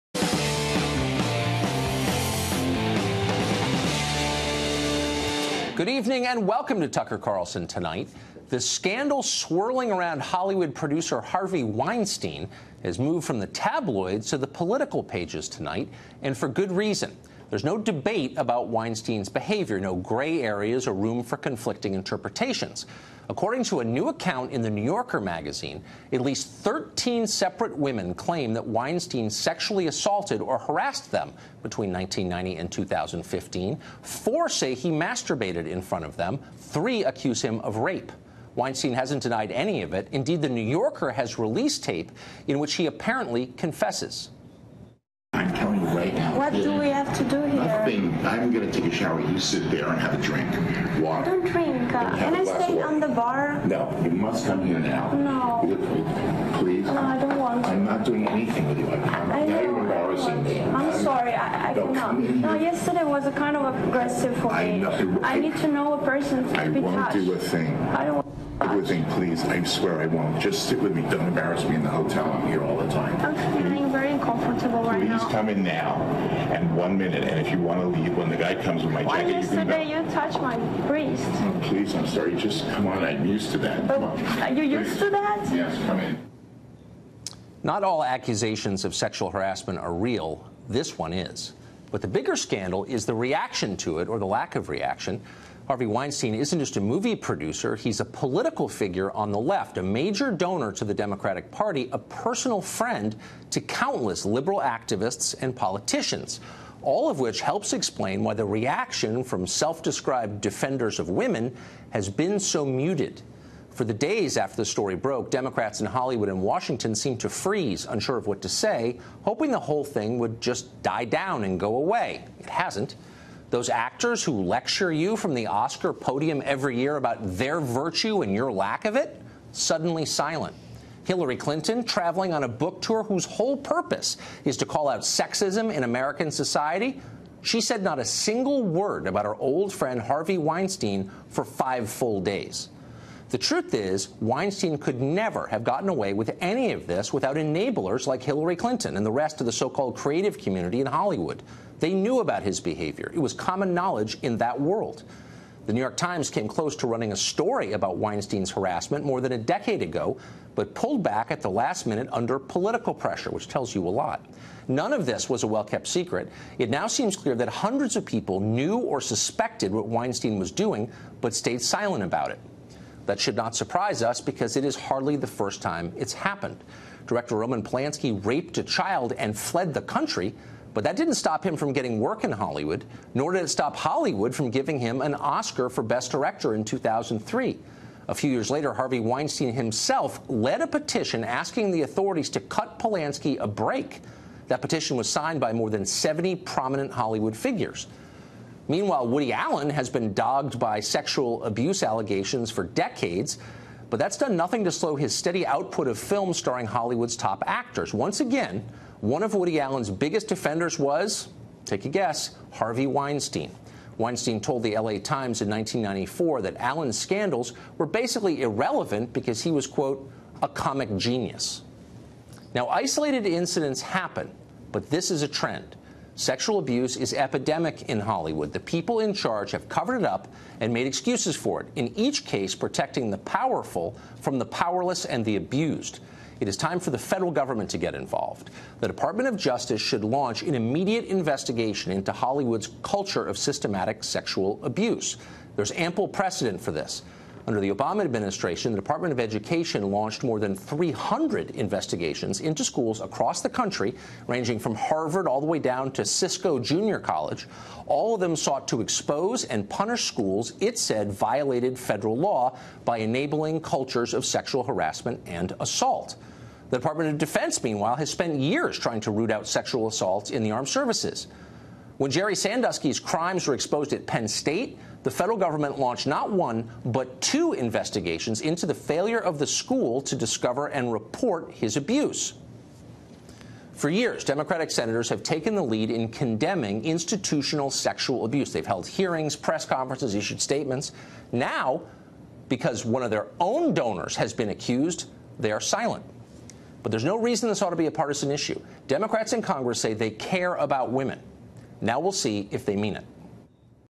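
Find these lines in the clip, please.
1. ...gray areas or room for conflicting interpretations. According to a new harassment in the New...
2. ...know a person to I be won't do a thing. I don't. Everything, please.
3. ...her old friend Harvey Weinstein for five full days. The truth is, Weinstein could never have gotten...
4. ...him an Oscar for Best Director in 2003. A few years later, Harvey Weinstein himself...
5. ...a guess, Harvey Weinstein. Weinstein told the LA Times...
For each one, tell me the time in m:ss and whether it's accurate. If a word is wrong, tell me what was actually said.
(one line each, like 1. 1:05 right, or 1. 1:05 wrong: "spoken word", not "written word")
1. 0:19 wrong: "account", not "harassment"
2. 1:05 right
3. 2:19 right
4. 3:04 right
5. 3:31 right.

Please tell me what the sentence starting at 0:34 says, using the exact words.
Four say he masturbated in front of them.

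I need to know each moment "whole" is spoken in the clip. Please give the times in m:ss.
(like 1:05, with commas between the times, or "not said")
1:59, 2:13.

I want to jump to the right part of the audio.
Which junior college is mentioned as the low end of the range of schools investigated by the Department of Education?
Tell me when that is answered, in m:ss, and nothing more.
4:16.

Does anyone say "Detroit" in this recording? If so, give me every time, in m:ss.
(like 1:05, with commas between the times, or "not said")
not said.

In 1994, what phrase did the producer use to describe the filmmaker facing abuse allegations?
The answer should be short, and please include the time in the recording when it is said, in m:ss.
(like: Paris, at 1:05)
comic genius, at 3:40.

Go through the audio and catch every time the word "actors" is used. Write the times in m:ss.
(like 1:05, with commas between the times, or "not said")
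2:03, 3:27.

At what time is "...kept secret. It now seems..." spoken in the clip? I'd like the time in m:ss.
2:45.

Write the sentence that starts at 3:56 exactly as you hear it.
It is time for the federal government to get involved.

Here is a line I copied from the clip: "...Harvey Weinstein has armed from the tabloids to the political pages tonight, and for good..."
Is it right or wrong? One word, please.
wrong.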